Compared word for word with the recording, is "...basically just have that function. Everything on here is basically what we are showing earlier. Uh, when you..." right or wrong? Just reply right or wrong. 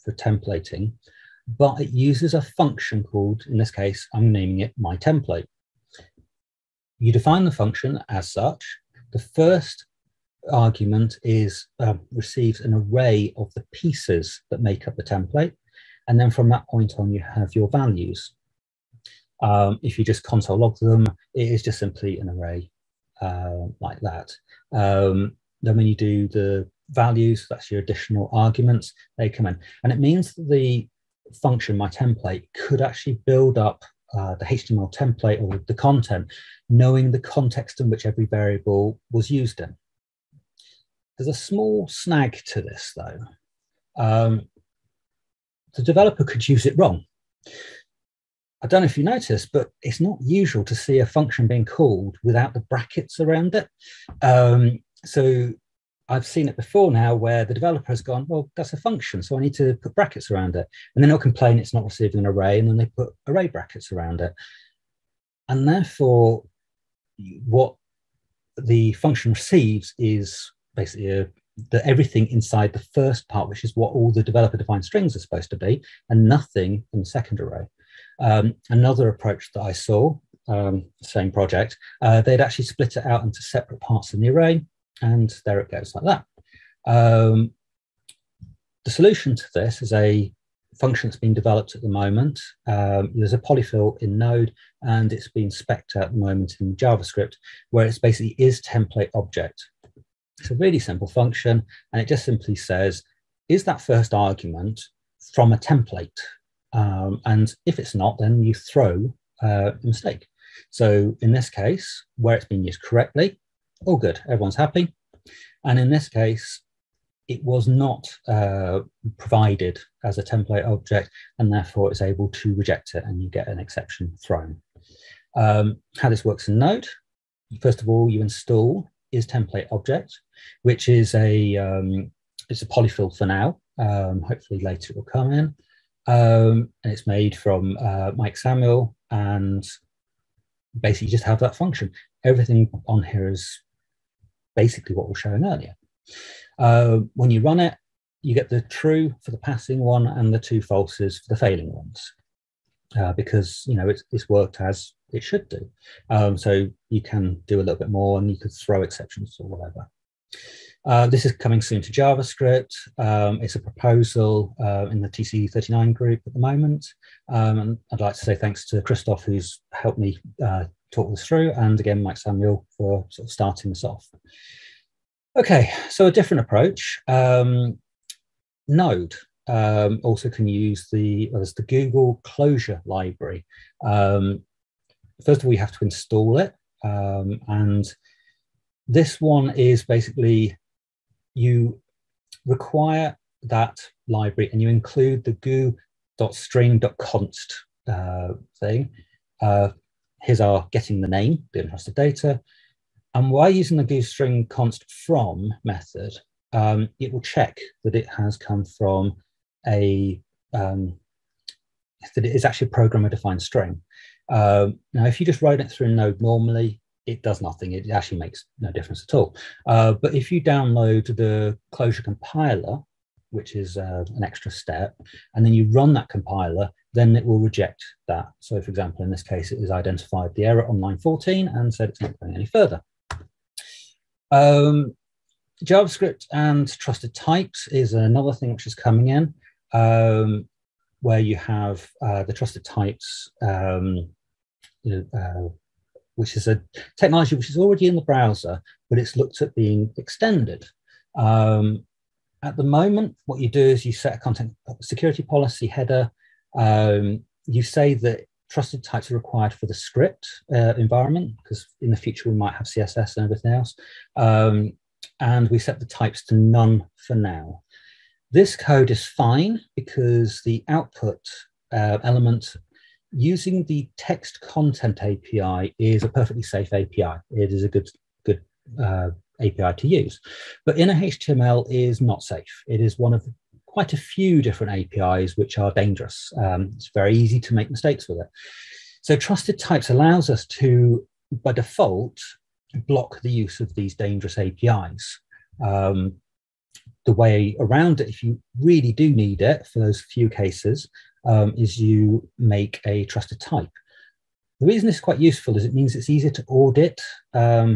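right.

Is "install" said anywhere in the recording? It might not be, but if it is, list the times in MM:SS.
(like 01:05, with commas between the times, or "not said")
02:08, 03:05.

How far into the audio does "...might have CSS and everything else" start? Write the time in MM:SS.
04:22.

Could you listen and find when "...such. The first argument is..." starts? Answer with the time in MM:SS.
00:08.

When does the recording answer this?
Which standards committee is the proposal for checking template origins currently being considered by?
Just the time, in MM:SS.
02:45.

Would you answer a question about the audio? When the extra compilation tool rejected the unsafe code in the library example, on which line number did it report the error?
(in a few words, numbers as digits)
14.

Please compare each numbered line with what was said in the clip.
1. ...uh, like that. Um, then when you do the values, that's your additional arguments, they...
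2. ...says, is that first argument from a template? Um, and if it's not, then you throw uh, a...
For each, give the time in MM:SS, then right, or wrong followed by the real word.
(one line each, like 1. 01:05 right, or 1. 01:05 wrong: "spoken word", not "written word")
1. 00:23 right
2. 01:42 right.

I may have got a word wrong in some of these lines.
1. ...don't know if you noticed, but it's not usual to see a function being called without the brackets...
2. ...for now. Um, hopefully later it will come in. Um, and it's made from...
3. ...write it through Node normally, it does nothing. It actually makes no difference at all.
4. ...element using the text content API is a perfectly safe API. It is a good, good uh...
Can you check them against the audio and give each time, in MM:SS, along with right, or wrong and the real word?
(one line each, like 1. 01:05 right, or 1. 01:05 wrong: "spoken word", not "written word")
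1. 00:48 right
2. 02:13 right
3. 03:35 right
4. 04:32 right.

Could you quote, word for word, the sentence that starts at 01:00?
And then they'll complain it's not receiving an array, and then they put array brackets around it.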